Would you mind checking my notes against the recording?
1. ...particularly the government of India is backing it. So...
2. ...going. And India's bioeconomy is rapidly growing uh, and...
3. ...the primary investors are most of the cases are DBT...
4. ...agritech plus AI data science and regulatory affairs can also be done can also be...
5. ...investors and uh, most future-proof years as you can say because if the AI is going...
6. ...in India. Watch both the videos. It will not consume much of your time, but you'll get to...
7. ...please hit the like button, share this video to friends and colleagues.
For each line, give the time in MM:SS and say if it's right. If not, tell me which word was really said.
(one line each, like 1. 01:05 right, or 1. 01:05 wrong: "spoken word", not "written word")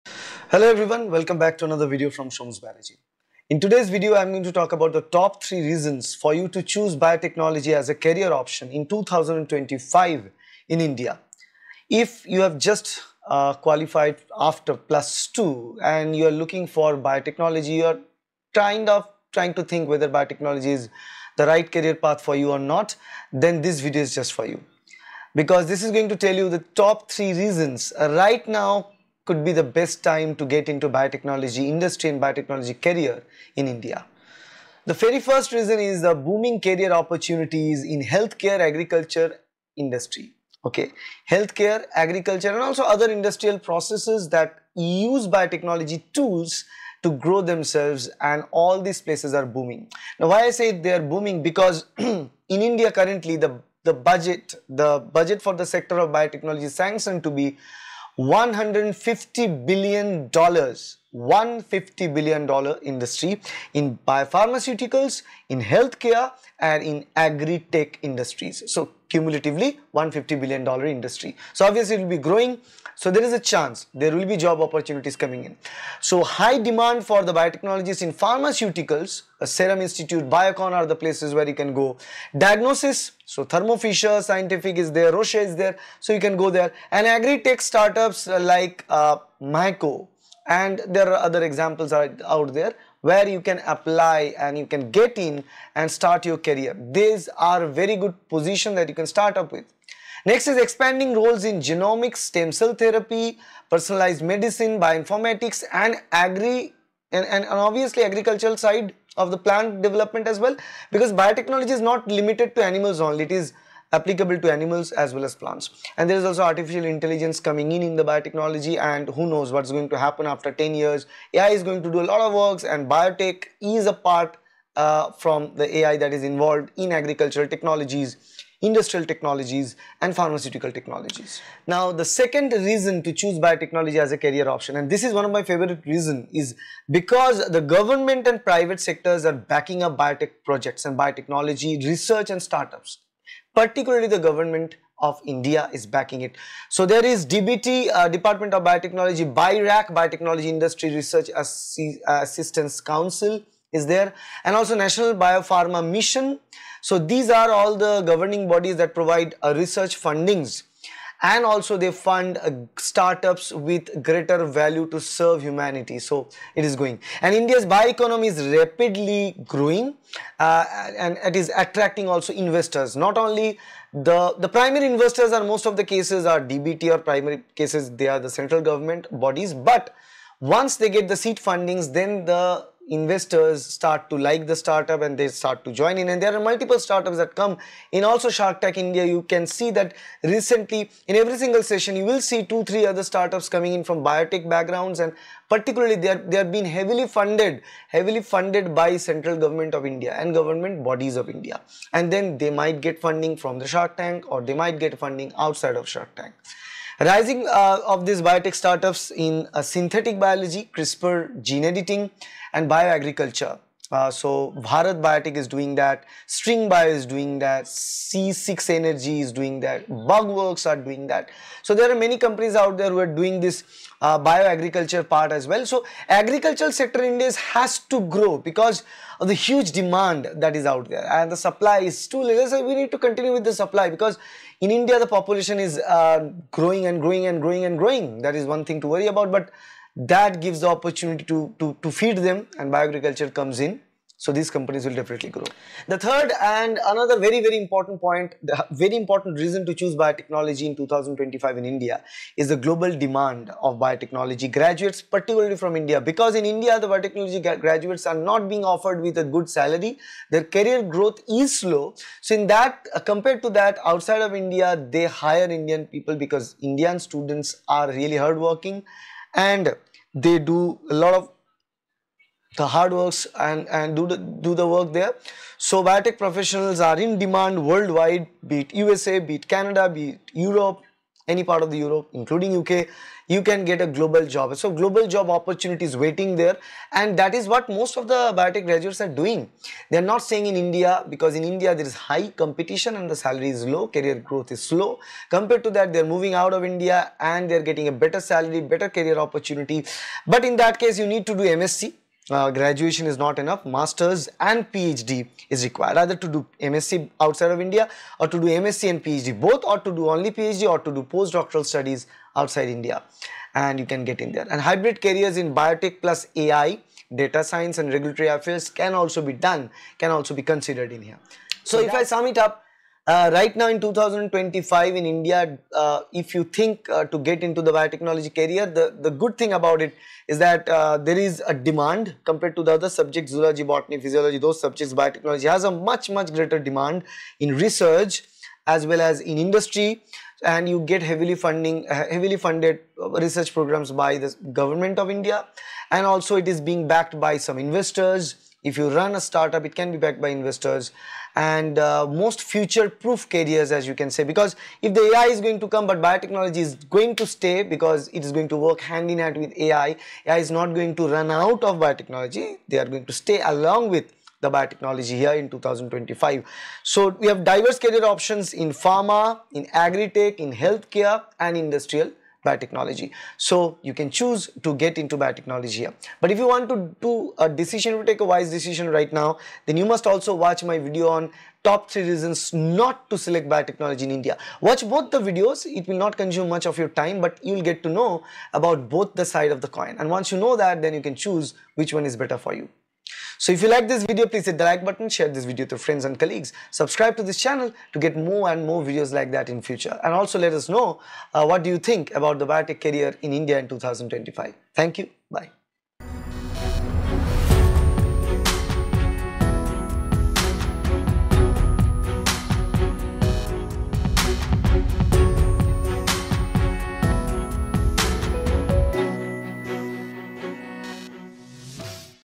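1. 02:23 right
2. 02:46 right
3. 02:54 right
4. 05:15 wrong: "biotech", not "agritech"
5. 05:50 wrong: "careers", not "years"
6. 06:24 right
7. 06:34 right.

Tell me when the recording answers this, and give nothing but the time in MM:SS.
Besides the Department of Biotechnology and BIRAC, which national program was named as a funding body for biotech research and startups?
02:34.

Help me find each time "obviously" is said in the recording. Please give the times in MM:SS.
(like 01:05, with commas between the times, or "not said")
01:11, 01:47.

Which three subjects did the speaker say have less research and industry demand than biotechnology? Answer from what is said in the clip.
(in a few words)
Zoology, botany, physiology.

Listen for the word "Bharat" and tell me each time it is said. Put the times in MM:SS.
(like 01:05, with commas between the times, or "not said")
03:34.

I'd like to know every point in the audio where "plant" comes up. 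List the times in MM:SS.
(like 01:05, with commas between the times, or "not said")
01:49, 01:55.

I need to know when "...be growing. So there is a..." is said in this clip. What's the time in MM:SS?
01:12.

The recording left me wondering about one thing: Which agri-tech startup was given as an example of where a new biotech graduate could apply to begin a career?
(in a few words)
Myco.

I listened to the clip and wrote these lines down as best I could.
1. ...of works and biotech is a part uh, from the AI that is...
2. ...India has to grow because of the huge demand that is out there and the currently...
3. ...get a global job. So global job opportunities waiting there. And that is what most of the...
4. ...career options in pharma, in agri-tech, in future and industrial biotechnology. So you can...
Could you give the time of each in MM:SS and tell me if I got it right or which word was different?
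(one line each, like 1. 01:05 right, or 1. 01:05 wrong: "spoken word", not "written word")
1. 02:02 right
2. 03:47 wrong: "supply", not "currently"
3. 04:43 right
4. 06:07 wrong: "healthcare", not "future".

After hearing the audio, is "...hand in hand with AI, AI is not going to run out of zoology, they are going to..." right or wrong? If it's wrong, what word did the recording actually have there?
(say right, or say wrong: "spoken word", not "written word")
wrong: "biotechnology", not "zoology".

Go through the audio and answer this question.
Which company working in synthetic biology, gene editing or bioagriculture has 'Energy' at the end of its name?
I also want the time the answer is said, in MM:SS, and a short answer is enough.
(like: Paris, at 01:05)
C6 Energy, at 03:37.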